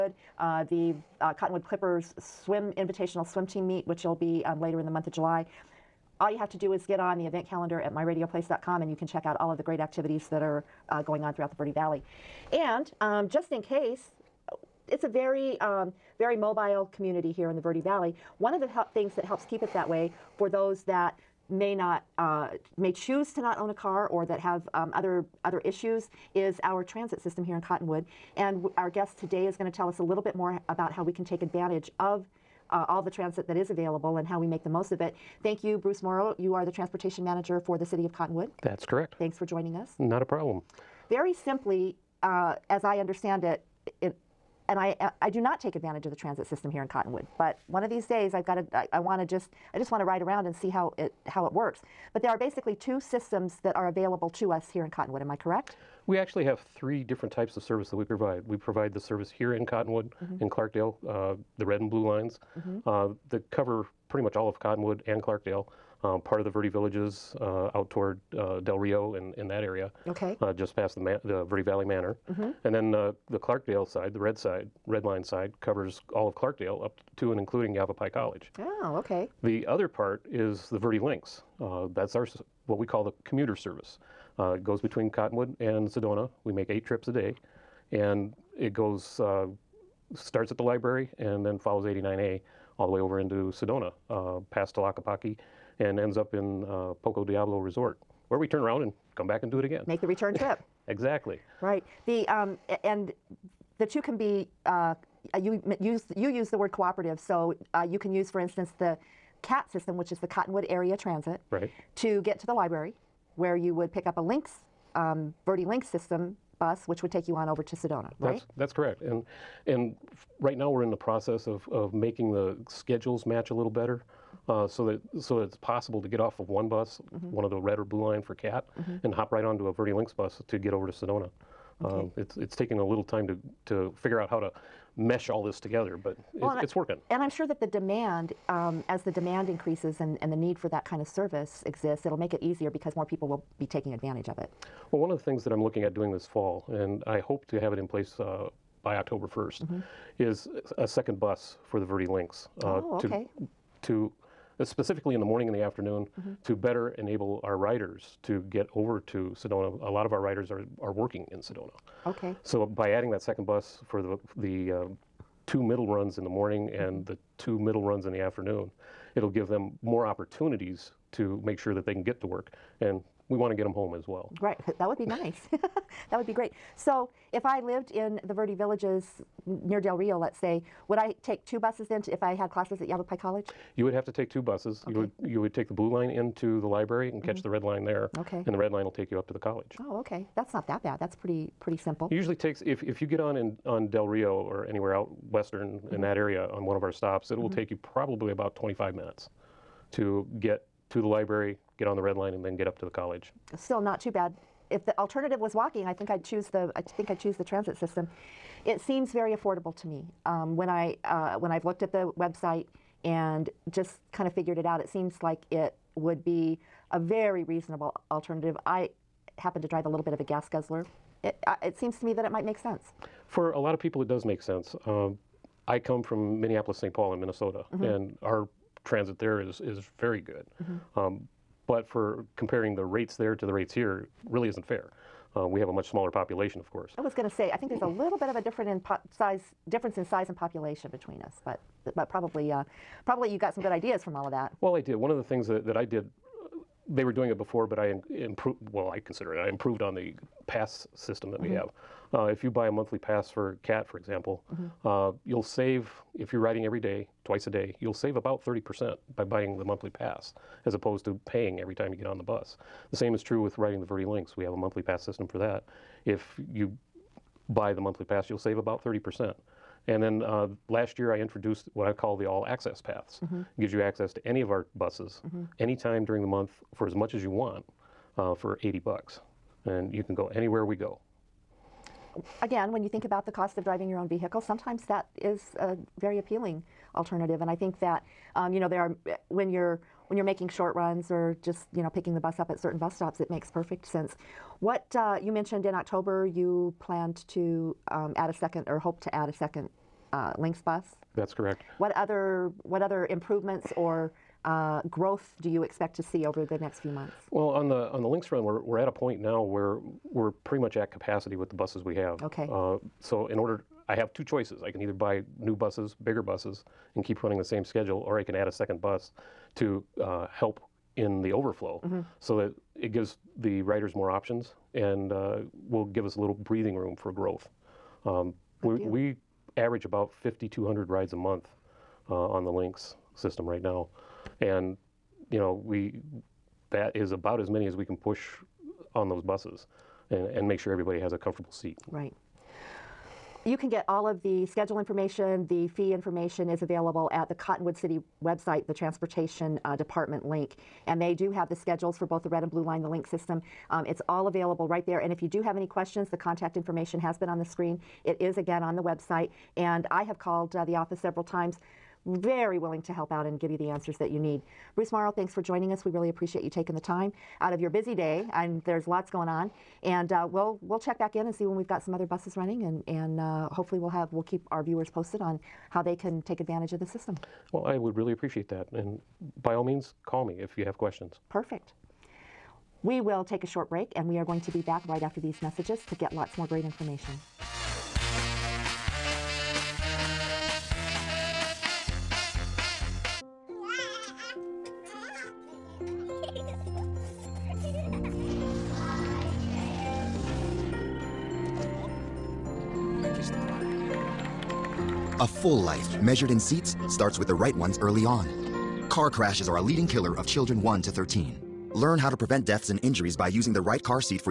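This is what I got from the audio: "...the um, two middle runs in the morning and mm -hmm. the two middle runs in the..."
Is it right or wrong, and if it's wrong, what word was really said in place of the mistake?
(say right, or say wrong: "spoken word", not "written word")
right.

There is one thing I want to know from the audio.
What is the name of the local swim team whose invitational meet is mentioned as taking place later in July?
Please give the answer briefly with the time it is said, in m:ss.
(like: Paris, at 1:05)
Cottonwood Clippers, at 0:01.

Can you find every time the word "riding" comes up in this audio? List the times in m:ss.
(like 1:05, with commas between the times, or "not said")
4:16, 4:23.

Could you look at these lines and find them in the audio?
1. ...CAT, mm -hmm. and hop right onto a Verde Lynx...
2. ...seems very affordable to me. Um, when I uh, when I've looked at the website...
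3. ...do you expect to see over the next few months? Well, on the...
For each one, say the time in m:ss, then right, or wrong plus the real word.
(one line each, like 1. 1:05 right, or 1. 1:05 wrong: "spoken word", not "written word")
1. 2:08 right
2. 3:28 right
3. 5:05 right.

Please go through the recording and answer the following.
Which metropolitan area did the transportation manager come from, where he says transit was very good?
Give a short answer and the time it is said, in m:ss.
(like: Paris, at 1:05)
Minneapolis, St. Paul, at 3:46.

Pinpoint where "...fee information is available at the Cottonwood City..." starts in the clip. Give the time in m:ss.
5:45.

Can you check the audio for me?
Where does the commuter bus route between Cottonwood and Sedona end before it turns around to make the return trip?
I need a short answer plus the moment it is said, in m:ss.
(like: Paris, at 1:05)
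Poco Diablo Resort, at 1:37.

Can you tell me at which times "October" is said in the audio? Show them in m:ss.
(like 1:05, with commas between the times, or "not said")
2:28, 4:55.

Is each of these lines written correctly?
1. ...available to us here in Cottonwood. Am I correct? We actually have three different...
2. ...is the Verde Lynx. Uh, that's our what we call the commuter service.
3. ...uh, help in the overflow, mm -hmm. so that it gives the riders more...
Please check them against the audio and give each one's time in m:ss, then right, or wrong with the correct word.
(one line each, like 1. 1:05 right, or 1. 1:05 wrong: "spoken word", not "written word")
1. 0:53 right
2. 1:20 right
3. 5:20 right.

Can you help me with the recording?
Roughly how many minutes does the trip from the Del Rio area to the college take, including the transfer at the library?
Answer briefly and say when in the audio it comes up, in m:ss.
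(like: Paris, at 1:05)
25 minutes, at 3:18.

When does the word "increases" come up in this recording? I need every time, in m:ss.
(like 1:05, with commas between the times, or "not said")
2:19.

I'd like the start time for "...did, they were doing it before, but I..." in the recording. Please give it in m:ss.
4:05.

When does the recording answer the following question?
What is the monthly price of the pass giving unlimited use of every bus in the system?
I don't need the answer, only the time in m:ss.
4:38.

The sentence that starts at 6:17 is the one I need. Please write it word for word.
Well, I would really appreciate that, and by all means, call me if you have questions.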